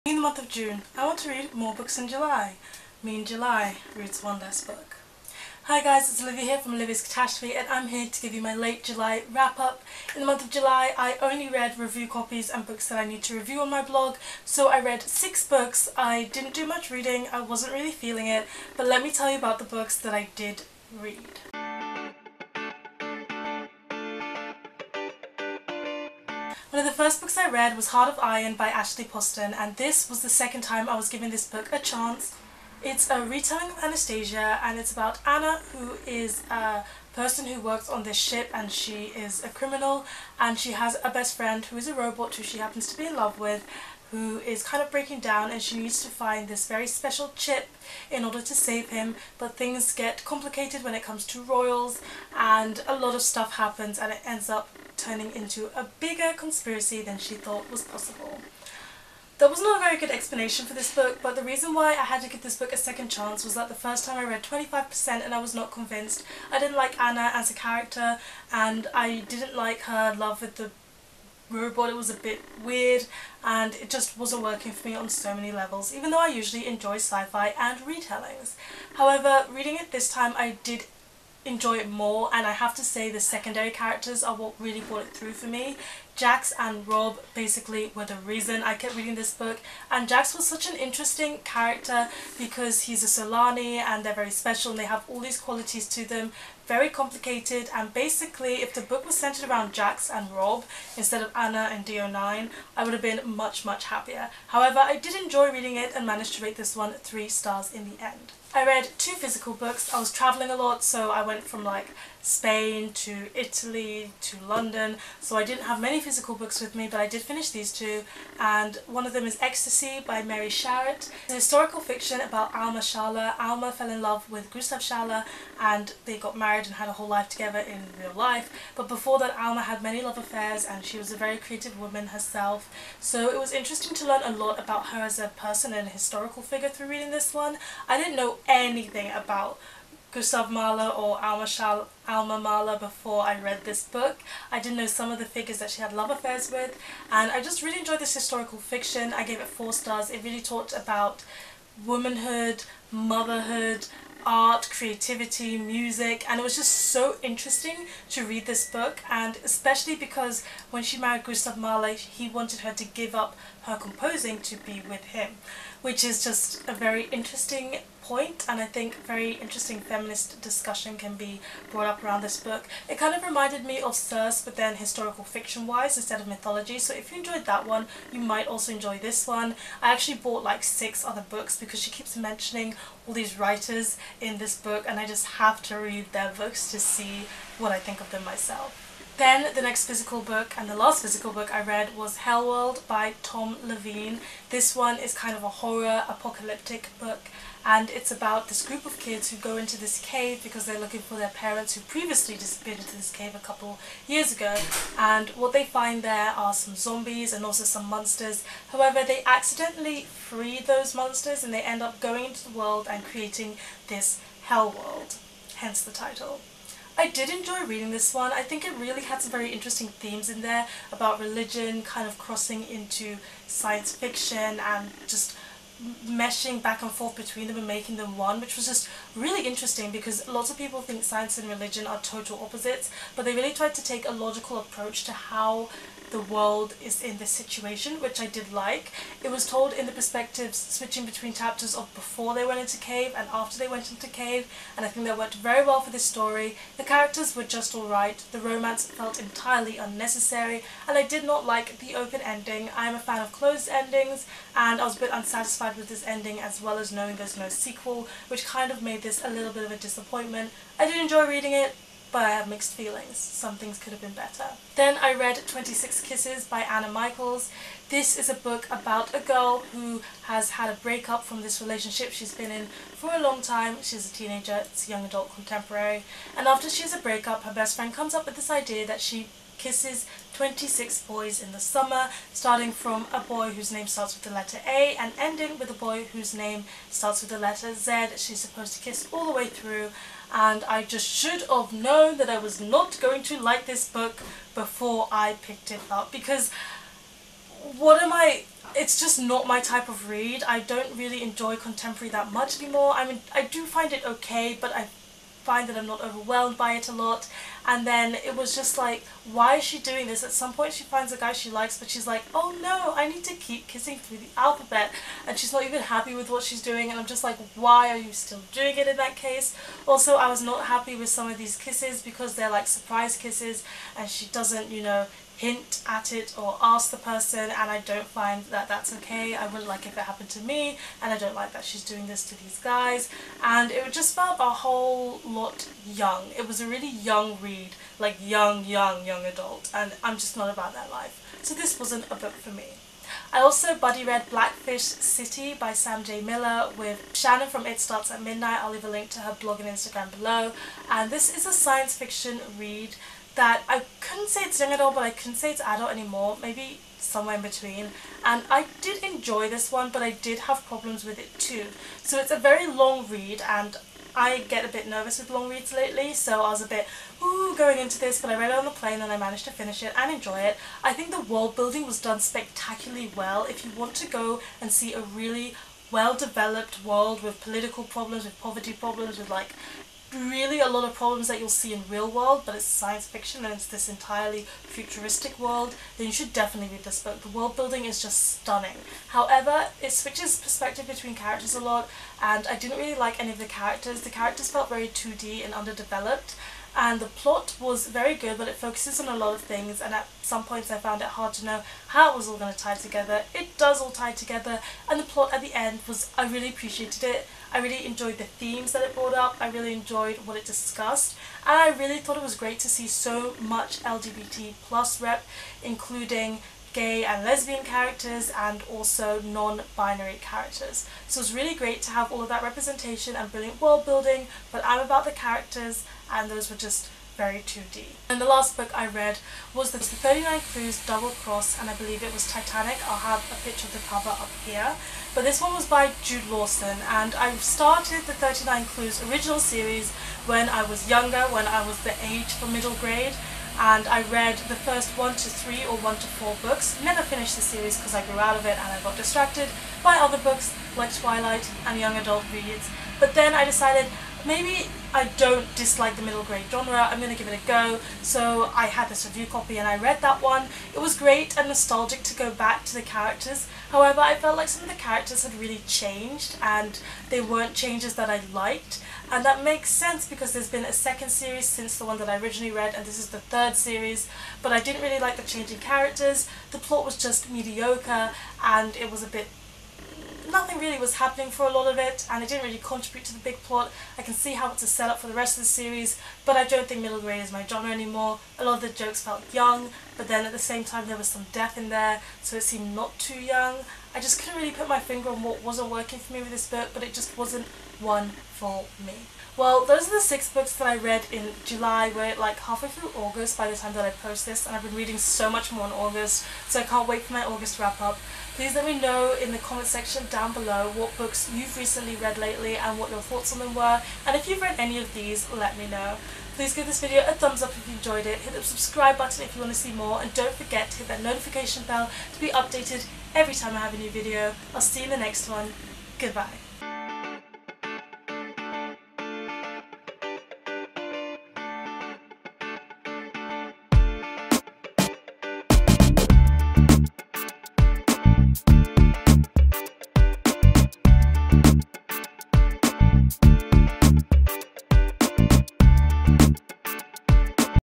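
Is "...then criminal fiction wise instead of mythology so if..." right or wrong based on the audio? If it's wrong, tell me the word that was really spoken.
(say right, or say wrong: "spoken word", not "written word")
wrong: "historical", not "criminal".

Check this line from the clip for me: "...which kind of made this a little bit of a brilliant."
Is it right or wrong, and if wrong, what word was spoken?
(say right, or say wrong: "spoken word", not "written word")
wrong: "disappointment", not "brilliant".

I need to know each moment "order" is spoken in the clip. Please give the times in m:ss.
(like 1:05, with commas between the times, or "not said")
0:48.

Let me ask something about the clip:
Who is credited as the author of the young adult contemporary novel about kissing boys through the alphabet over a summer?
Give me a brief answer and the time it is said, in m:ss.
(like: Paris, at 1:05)
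Anna Michaels, at 4:26.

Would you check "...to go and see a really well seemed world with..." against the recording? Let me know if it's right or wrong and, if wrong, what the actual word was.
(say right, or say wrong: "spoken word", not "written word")
wrong: "developed", not "seemed".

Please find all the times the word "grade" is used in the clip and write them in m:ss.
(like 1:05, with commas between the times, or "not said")
7:22, 7:36, 8:06.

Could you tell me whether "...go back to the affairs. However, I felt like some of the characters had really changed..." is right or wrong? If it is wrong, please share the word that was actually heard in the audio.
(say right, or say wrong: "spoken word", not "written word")
wrong: "characters", not "affairs".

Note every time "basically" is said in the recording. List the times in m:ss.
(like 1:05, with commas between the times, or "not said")
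1:27, 1:37.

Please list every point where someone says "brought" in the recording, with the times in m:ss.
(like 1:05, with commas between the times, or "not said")
1:24, 2:51, 6:48.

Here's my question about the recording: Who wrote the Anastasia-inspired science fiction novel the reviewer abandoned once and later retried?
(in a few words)
Ashley Poston.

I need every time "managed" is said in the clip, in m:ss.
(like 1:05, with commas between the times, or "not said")
1:46, 6:09.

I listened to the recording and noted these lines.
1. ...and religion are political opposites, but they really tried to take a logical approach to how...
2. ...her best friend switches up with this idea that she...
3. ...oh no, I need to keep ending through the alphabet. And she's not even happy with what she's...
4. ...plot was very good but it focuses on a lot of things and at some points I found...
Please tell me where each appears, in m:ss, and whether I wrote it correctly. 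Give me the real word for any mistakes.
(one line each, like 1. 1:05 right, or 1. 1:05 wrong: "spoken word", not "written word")
1. 3:51 wrong: "total", not "political"
2. 4:37 wrong: "comes", not "switches"
3. 5:12 wrong: "kissing", not "ending"
4. 6:37 right.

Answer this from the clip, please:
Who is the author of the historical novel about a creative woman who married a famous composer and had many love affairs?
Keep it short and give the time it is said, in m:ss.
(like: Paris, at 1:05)
Mary Sharratt, at 2:00.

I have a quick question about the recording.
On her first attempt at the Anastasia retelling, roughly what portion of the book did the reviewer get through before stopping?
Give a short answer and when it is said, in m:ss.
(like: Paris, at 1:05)
25%, at 1:04.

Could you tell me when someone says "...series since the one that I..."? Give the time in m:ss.
7:51.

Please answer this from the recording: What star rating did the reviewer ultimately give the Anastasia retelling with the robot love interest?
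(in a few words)
3 stars.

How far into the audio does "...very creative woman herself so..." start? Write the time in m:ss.
2:11.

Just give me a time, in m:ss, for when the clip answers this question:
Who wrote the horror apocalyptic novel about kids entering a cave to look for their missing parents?
3:13.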